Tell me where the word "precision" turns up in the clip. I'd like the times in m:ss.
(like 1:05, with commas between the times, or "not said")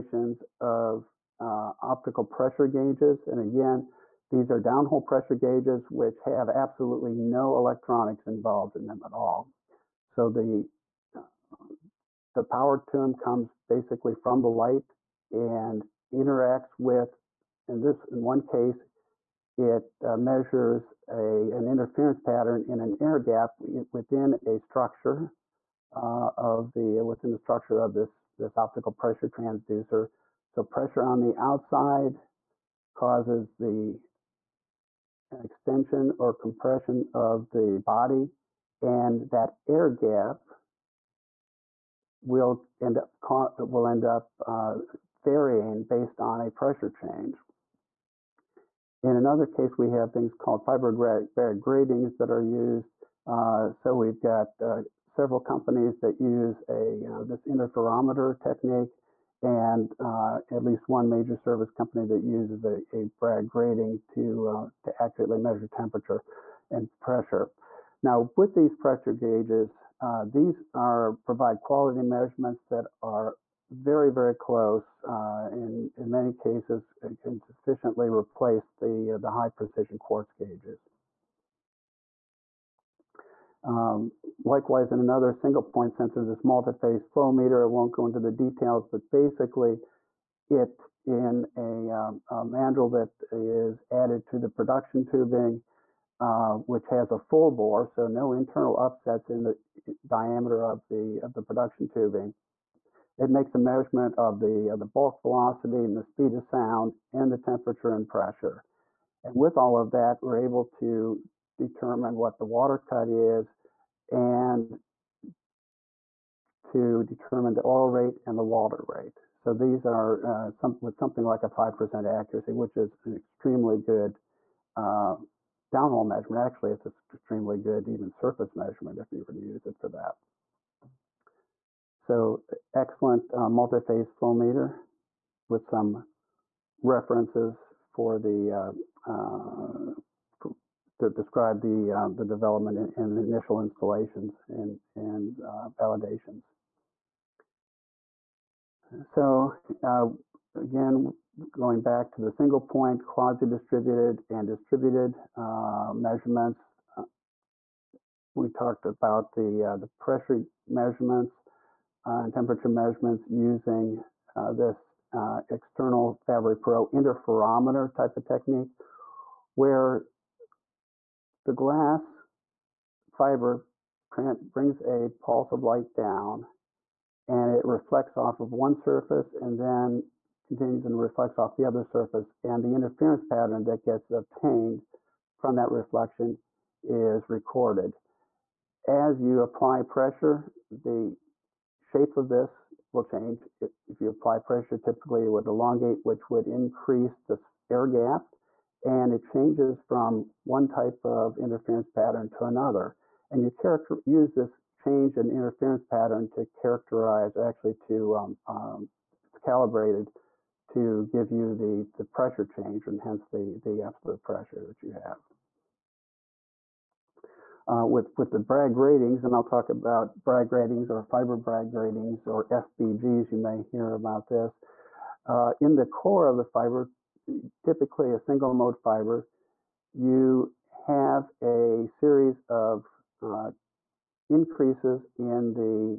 1:19.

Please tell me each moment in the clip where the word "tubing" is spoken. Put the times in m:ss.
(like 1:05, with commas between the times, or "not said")
1:35, 1:41.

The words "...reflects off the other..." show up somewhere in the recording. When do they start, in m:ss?
3:00.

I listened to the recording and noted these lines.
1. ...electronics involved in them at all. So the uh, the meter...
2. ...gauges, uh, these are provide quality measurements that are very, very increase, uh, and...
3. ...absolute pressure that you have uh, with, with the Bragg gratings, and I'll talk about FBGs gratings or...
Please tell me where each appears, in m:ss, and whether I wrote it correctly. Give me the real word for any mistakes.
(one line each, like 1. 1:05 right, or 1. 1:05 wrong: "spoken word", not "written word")
1. 0:07 wrong: "power", not "meter"
2. 1:09 wrong: "close", not "increase"
3. 3:33 wrong: "Bragg", not "FBGs".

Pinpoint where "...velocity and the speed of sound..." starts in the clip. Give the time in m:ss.
1:45.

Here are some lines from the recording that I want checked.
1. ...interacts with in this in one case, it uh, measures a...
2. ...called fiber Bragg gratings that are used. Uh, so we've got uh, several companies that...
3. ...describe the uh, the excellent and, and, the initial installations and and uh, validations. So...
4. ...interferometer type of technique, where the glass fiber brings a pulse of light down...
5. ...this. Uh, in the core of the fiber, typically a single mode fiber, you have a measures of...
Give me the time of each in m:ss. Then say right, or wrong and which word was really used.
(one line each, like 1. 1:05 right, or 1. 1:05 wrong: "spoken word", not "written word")
1. 0:16 right
2. 0:50 right
3. 2:21 wrong: "development", not "excellent"
4. 2:46 right
5. 3:44 wrong: "series", not "measures".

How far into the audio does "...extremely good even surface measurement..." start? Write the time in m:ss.
2:07.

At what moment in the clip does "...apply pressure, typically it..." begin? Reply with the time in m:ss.
3:14.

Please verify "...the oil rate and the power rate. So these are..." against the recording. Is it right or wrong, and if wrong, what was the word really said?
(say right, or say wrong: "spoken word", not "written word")
wrong: "water", not "power".